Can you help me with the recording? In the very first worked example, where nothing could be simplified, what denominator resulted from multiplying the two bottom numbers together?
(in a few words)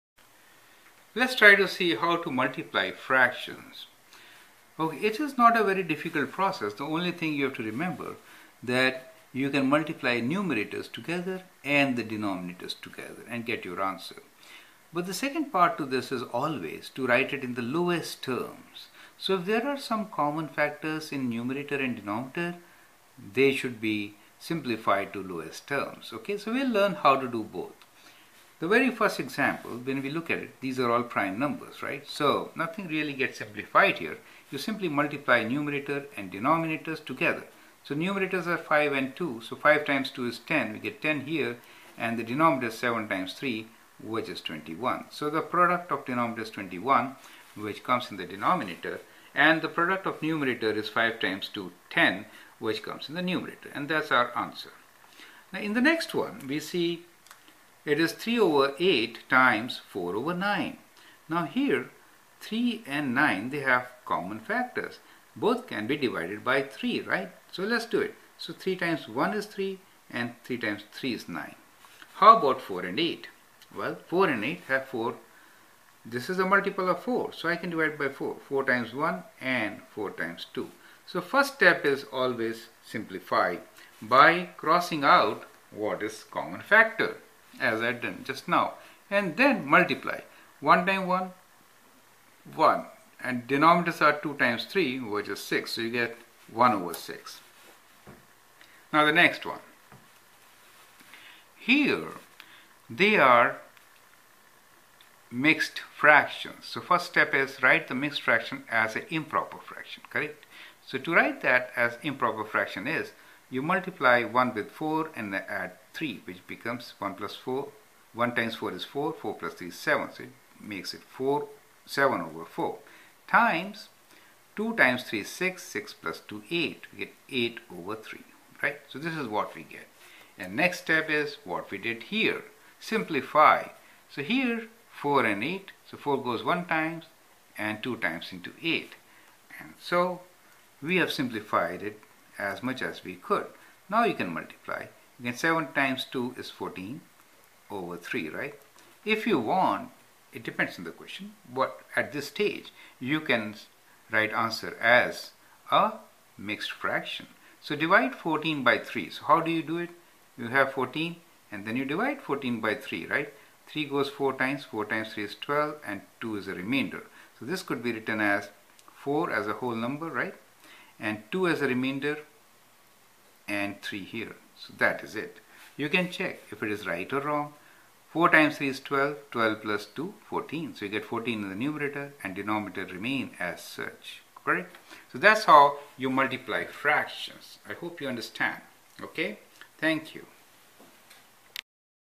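21.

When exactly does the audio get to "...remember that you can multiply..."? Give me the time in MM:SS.
00:07.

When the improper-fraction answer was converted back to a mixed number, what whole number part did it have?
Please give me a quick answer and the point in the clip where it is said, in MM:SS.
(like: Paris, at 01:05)
4, at 02:49.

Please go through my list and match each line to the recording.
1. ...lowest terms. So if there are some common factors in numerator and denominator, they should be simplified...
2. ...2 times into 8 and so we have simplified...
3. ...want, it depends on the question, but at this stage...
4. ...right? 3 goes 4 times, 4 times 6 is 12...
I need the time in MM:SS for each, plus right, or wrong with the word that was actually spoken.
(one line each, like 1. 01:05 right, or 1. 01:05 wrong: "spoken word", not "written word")
1. 00:17 right
2. 02:17 right
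3. 02:29 right
4. 02:43 wrong: "3", not "6".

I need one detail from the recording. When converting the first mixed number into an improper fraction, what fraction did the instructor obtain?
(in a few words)
7/4.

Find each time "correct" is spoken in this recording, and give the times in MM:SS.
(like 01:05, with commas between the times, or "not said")
01:50, 03:04.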